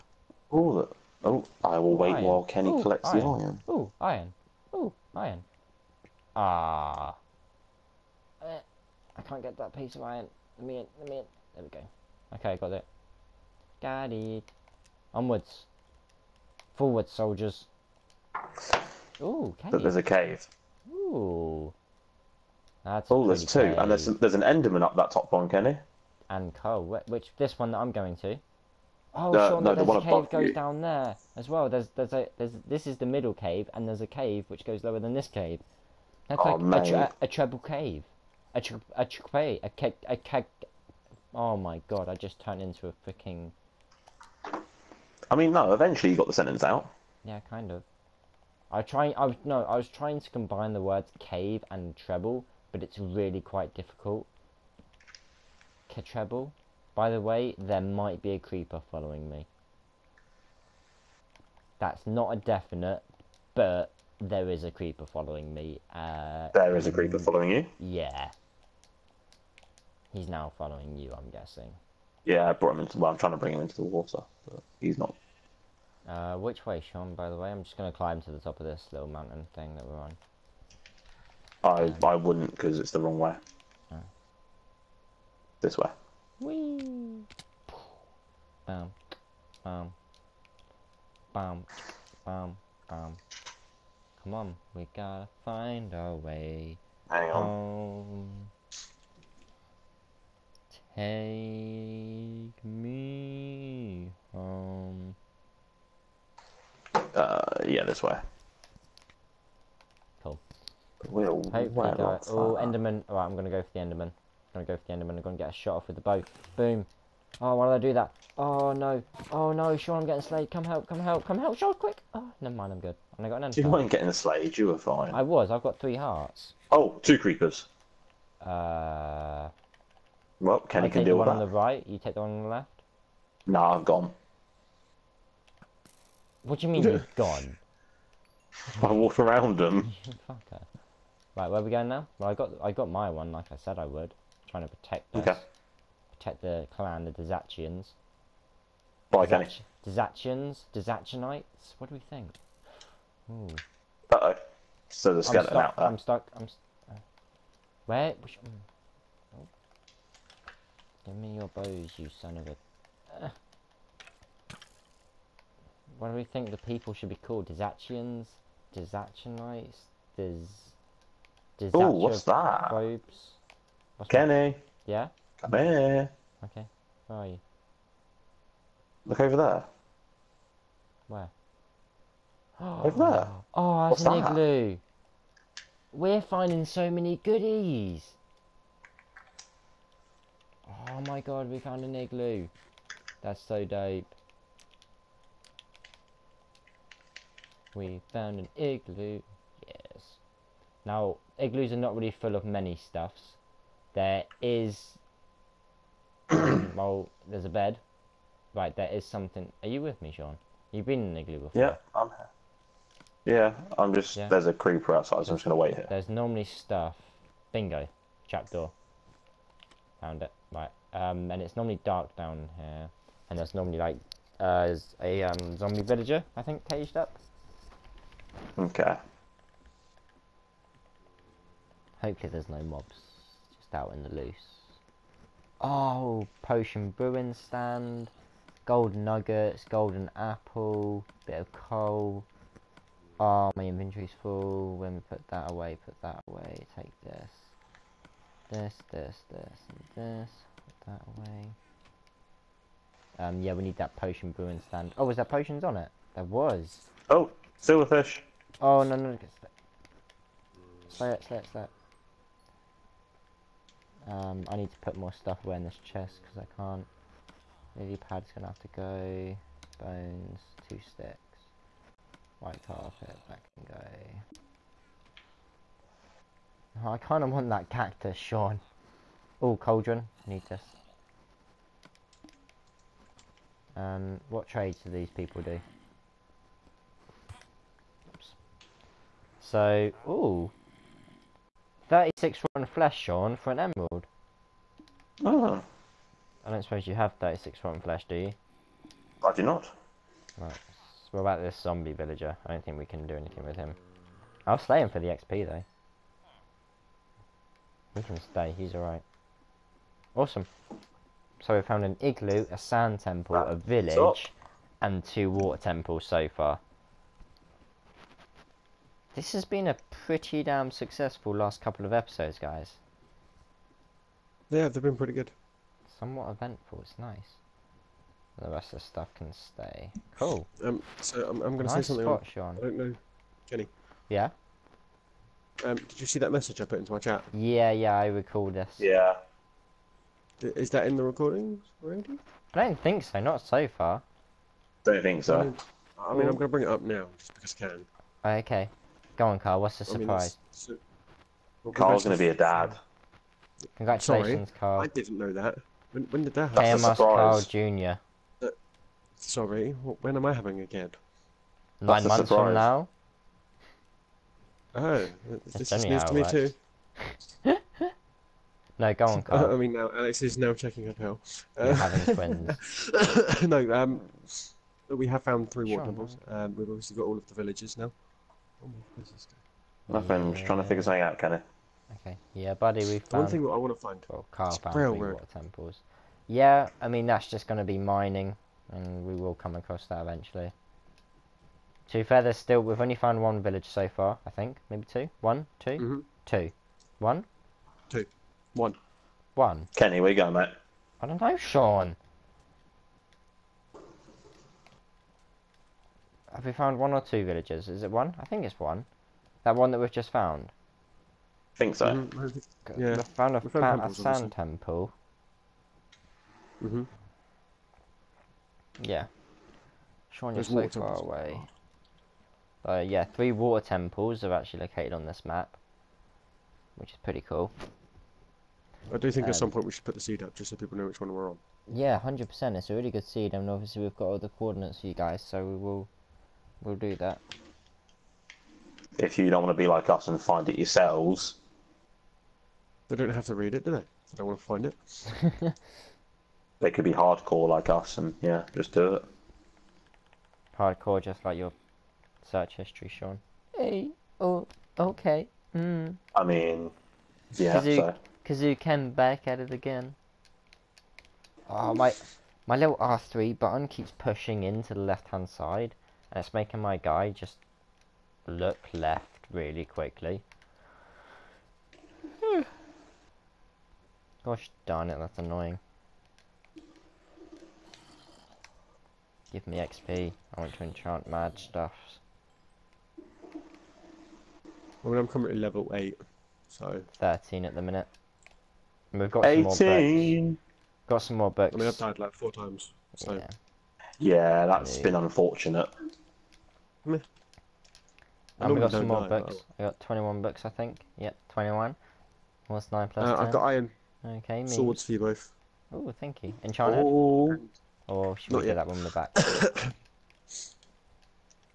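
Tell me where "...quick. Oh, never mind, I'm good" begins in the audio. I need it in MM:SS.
02:01.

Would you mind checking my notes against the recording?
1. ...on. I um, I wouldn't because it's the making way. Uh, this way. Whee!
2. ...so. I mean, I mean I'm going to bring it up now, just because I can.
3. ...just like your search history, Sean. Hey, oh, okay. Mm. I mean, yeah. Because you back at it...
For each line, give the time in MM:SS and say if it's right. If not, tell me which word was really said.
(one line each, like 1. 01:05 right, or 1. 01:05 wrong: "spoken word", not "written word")
1. 01:19 wrong: "wrong", not "making"
2. 05:45 right
3. 07:31 right.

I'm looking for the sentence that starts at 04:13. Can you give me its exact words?
Um, yeah, we need that potion brewing stand.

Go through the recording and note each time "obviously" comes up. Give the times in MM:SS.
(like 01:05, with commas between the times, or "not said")
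06:16, 07:13.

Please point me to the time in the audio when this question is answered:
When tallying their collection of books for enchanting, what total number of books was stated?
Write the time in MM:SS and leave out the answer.
08:19.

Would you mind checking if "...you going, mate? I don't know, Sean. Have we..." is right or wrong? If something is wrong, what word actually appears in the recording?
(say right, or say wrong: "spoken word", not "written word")
right.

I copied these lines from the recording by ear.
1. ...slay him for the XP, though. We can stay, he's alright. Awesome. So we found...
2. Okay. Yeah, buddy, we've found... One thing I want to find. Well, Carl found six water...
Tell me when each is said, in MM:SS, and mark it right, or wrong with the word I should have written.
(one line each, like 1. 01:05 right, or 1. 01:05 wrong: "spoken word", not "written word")
1. 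05:04 right
2. 06:22 wrong: "three", not "six".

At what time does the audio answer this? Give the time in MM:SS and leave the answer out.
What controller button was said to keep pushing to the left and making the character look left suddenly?
07:42.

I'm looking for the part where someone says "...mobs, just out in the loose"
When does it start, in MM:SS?
03:52.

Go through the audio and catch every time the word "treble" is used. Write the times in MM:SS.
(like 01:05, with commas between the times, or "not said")
00:37, 00:51, 00:56.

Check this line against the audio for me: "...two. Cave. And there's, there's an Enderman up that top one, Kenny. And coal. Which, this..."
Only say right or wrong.
right.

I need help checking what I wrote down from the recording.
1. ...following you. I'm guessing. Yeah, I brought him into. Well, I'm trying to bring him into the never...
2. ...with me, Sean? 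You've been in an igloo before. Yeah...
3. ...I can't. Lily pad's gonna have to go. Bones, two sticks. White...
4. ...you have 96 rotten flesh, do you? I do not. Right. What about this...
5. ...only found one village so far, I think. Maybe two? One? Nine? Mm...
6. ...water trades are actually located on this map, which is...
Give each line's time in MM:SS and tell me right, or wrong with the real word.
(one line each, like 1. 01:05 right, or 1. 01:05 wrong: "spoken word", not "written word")
1. 01:10 wrong: "water", not "never"
2. 03:29 right
3. 04:26 right
4. 04:56 wrong: "36", not "96"
5. 06:32 wrong: "Two", not "Nine"
6. 07:03 wrong: "temples", not "trades".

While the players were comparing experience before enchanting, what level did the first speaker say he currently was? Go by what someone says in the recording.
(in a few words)
8.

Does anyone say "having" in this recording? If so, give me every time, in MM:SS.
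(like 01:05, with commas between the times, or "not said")
06:00, 06:11.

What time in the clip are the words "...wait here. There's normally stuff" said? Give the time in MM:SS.
03:35.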